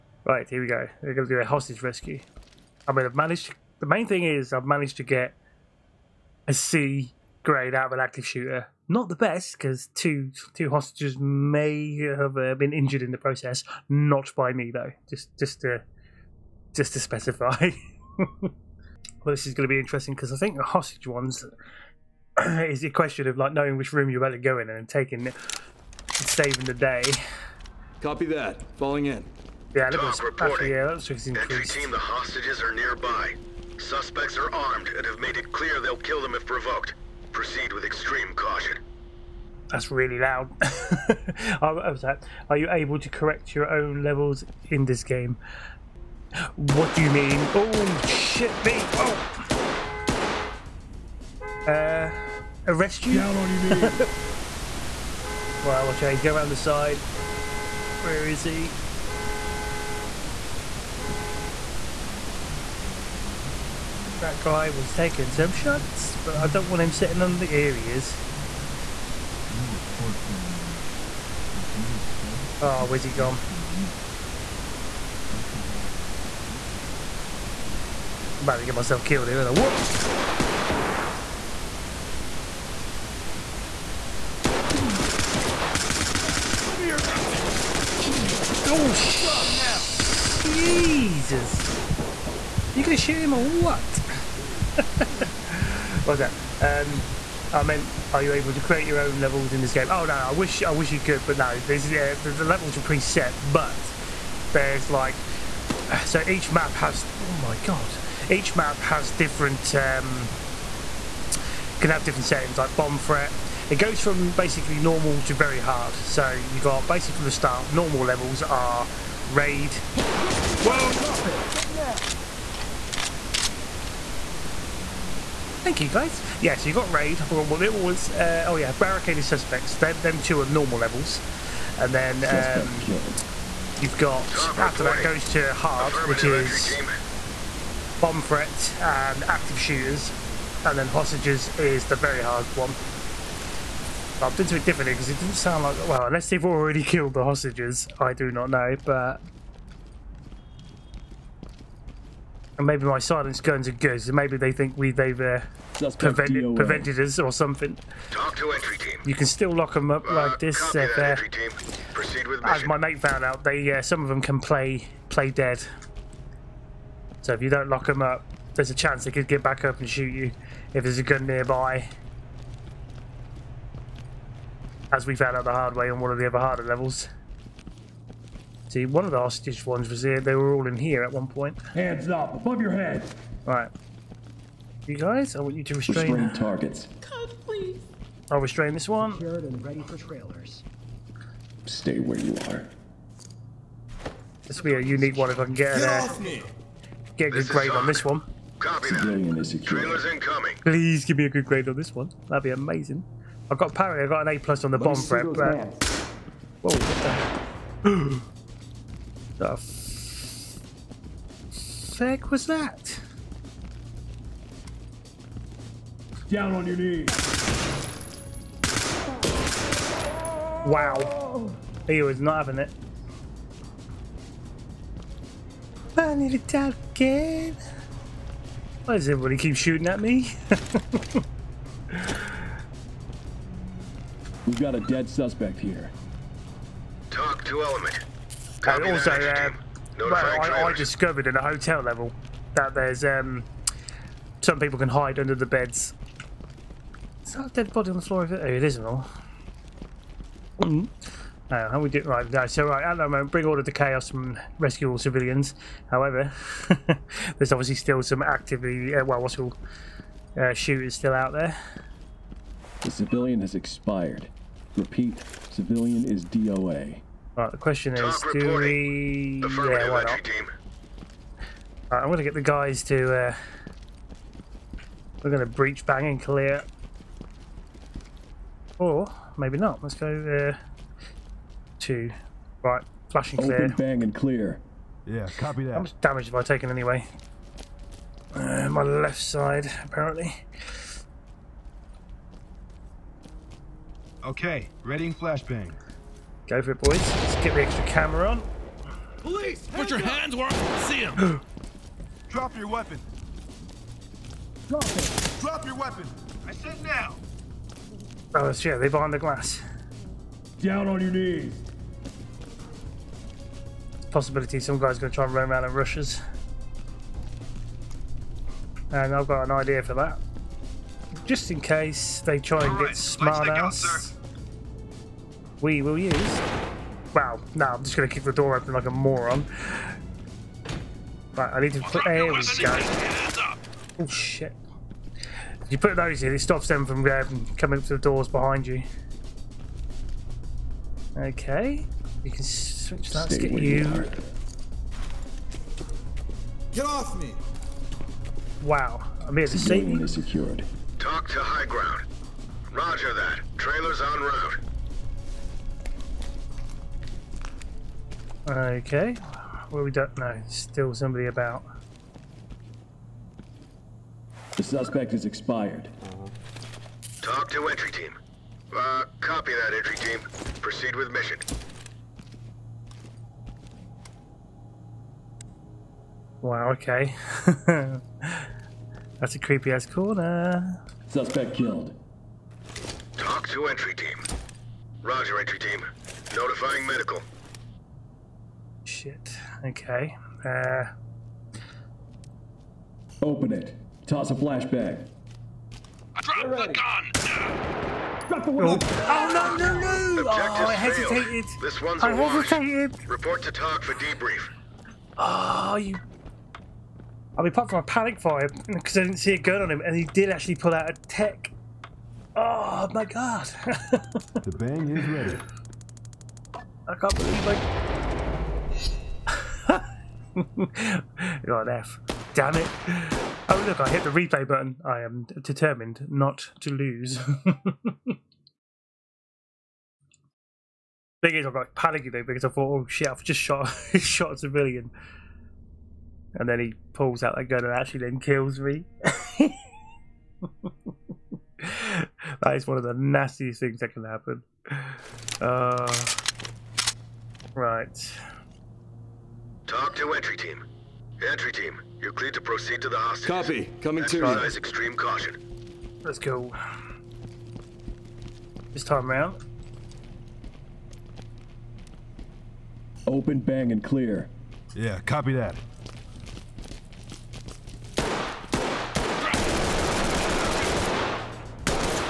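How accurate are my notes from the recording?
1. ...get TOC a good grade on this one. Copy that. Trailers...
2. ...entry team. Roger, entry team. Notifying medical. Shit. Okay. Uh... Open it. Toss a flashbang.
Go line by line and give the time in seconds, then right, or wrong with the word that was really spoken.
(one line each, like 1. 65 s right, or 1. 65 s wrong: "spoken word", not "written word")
1. 195 s wrong: "Get", not "TOC"
2. 383 s right.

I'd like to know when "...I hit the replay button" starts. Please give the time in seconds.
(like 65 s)
423 s.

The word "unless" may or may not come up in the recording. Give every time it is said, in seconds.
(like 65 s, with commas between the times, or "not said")
146 s.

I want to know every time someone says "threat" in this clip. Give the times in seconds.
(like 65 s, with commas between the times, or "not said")
112 s, 138 s.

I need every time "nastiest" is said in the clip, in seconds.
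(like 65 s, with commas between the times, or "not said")
442 s.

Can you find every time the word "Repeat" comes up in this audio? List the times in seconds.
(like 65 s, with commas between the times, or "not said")
264 s.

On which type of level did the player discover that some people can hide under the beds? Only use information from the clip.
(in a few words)
Hotel level.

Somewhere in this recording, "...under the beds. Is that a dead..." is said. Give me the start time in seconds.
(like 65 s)
245 s.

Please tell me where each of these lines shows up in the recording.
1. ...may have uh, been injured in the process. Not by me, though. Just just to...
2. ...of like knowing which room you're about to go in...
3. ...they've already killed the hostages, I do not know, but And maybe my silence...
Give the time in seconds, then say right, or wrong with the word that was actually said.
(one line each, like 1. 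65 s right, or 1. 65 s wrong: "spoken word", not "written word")
1. 11 s right
2. 23 s right
3. 146 s right.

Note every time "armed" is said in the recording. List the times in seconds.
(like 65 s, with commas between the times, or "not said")
34 s.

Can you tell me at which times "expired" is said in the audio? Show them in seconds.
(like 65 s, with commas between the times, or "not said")
263 s, 365 s.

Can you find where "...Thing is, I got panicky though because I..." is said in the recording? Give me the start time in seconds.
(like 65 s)
431 s.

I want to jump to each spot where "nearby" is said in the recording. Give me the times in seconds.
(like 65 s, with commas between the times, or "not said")
32 s, 171 s.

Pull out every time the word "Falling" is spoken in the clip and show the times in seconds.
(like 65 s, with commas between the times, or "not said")
28 s.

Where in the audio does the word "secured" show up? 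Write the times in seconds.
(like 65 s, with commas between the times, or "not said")
189 s, 350 s.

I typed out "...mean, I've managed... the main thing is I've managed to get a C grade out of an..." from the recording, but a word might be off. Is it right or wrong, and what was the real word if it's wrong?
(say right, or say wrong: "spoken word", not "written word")
right.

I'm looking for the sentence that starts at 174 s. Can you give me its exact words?
As we found out the hard way on one of the other harder levels.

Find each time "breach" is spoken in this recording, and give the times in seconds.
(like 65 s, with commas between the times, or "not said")
275 s.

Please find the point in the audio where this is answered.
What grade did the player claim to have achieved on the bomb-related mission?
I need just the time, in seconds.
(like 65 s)
204 s.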